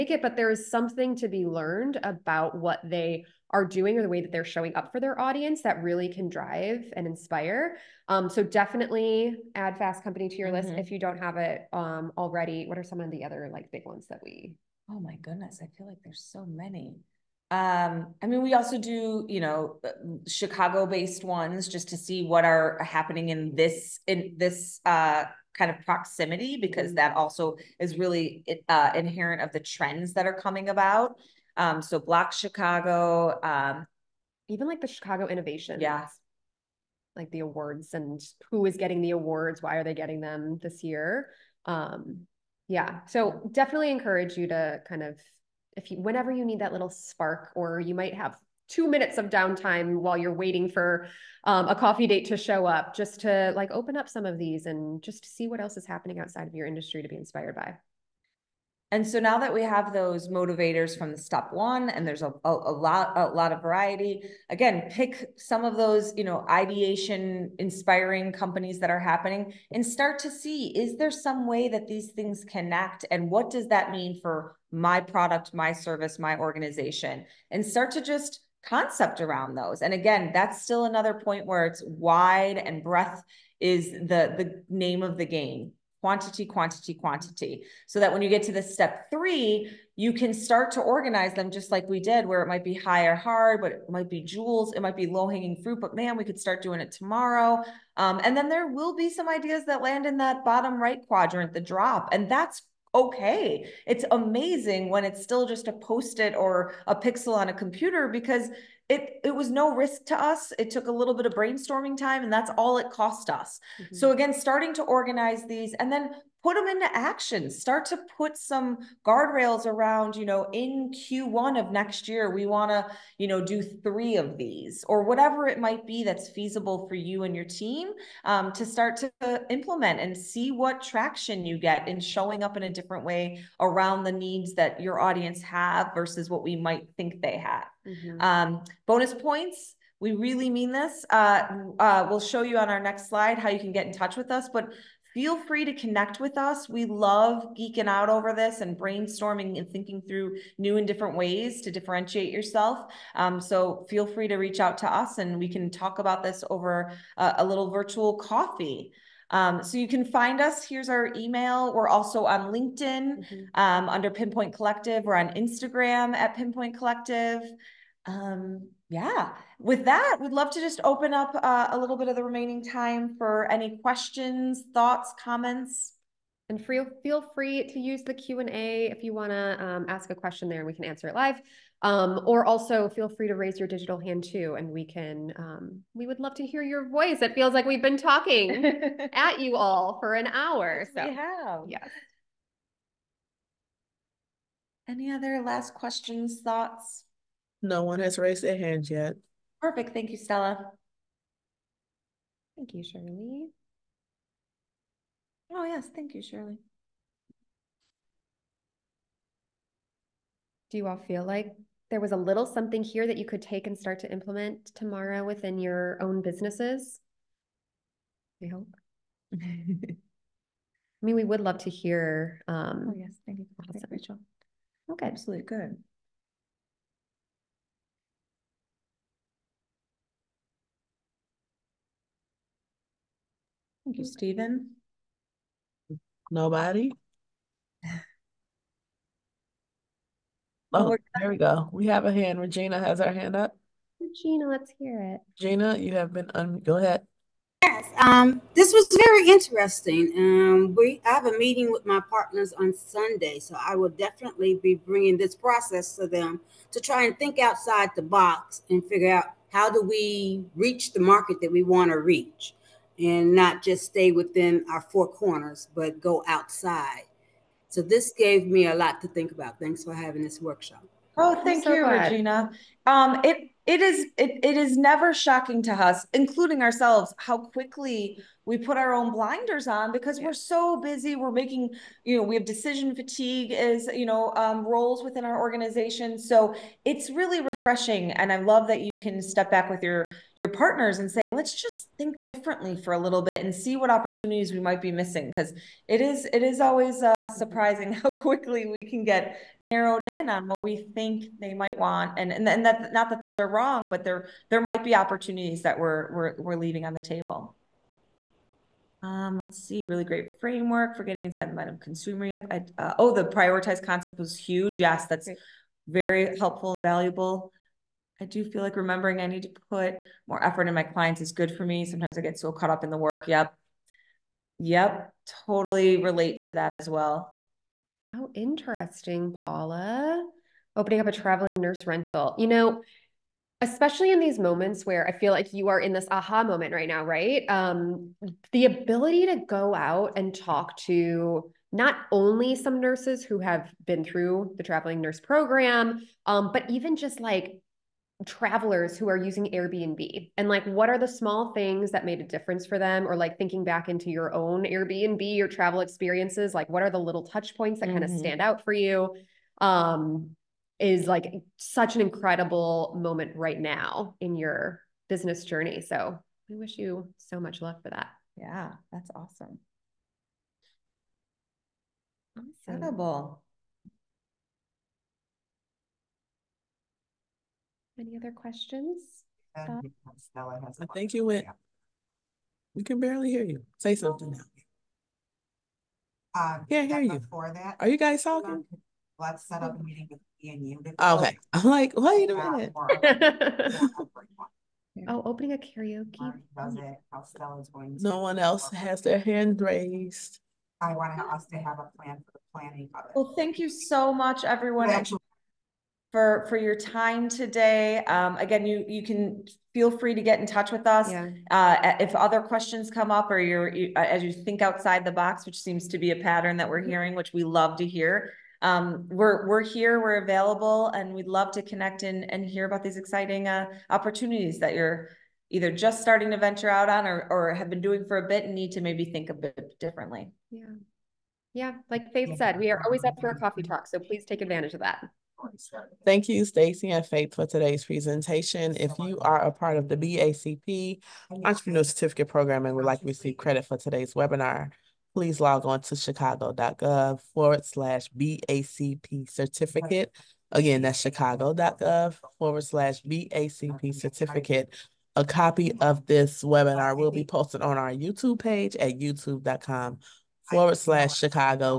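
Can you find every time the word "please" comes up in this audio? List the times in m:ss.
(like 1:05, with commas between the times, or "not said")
7:14, 7:25.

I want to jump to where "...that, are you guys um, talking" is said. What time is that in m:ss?
6:27.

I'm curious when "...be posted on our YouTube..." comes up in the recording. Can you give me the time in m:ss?
7:37.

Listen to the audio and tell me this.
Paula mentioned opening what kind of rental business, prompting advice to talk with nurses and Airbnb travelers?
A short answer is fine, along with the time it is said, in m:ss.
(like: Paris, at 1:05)
traveling nurse rental, at 5:31.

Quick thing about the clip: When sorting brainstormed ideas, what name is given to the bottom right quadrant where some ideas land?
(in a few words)
the drop.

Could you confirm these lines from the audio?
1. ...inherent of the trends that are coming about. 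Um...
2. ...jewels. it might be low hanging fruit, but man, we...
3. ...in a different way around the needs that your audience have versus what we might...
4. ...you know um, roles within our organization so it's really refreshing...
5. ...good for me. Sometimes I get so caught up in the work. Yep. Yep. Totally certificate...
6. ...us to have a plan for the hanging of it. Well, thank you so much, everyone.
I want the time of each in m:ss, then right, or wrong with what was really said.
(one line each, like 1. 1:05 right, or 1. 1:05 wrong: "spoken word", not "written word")
1. 0:28 right
2. 1:34 right
3. 2:12 right
4. 4:43 right
5. 5:21 wrong: "relate", not "certificate"
6. 6:41 wrong: "planning", not "hanging".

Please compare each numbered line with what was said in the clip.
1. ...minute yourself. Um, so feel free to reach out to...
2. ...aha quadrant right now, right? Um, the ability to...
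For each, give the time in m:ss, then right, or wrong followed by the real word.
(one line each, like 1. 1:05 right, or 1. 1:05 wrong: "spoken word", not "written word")
1. 2:31 wrong: "differentiate", not "minute"
2. 5:36 wrong: "moment", not "quadrant".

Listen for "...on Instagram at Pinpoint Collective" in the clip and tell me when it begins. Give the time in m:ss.
2:45.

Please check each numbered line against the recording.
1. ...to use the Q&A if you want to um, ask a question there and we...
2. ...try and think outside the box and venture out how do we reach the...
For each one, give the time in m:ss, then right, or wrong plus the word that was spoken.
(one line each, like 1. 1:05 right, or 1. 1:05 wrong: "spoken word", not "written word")
1. 2:57 right
2. 4:16 wrong: "figure", not "venture".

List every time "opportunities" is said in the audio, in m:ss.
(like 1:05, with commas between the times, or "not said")
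4:53, 5:04, 7:03.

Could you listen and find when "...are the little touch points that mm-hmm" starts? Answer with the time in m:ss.
5:56.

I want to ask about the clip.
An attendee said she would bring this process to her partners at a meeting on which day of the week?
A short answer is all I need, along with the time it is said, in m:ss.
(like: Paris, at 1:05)
Sunday, at 4:12.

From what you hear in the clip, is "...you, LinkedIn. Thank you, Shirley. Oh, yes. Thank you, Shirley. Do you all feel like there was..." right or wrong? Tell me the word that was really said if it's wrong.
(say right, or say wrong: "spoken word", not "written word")
wrong: "Stella", not "LinkedIn".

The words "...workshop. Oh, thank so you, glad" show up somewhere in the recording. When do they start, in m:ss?
4:30.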